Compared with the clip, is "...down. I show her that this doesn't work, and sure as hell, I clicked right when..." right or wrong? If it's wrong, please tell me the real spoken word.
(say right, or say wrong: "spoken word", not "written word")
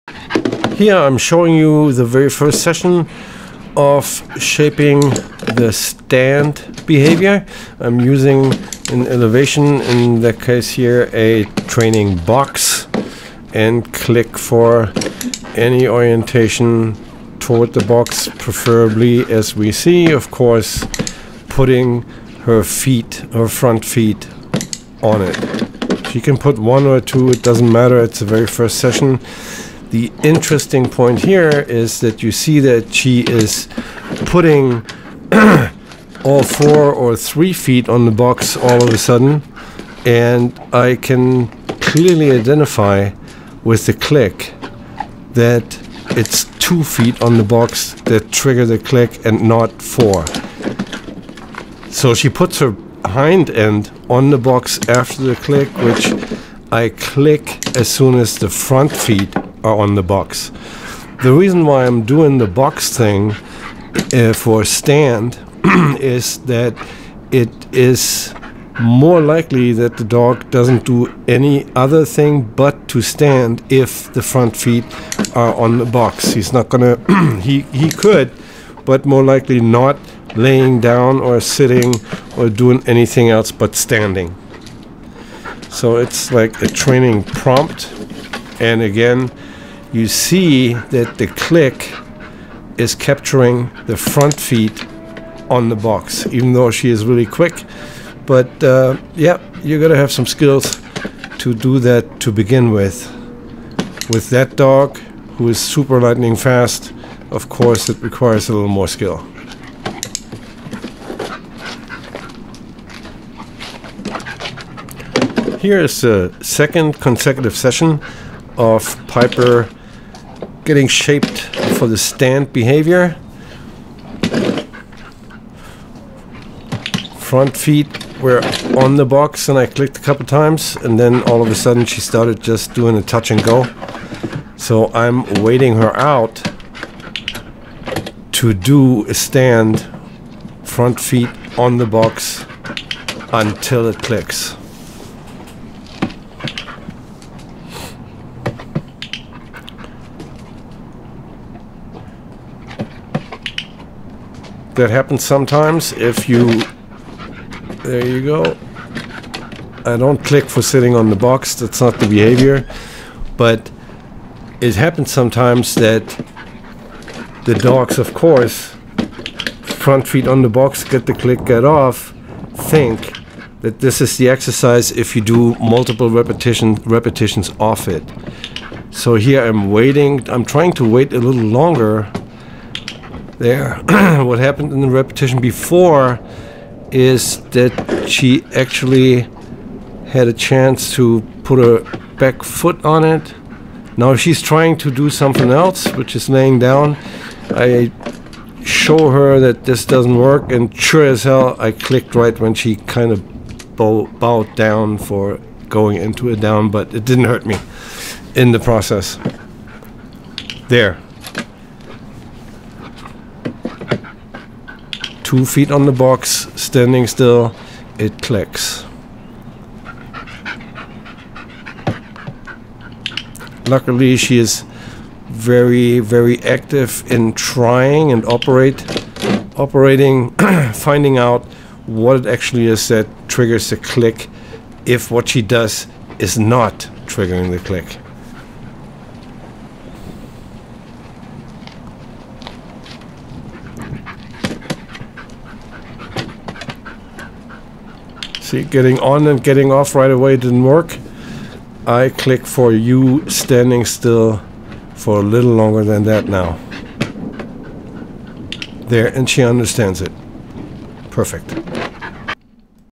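right.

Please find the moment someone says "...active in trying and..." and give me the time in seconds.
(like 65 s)
226 s.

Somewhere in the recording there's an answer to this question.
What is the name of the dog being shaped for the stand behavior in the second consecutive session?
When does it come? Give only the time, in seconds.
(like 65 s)
119 s.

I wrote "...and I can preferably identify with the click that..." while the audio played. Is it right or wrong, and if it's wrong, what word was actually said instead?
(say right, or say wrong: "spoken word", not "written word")
wrong: "clearly", not "preferably".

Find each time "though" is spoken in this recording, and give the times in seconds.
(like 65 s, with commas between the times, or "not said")
96 s.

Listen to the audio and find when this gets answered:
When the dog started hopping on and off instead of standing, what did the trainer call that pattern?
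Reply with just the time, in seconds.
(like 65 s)
133 s.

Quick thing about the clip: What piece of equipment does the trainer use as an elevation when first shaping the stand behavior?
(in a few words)
training box.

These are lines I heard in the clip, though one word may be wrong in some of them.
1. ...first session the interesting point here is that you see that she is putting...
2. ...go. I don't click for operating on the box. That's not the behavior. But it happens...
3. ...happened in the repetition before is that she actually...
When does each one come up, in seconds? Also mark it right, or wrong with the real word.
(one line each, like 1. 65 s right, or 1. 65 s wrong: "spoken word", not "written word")
1. 28 s right
2. 158 s wrong: "sitting", not "operating"
3. 184 s right.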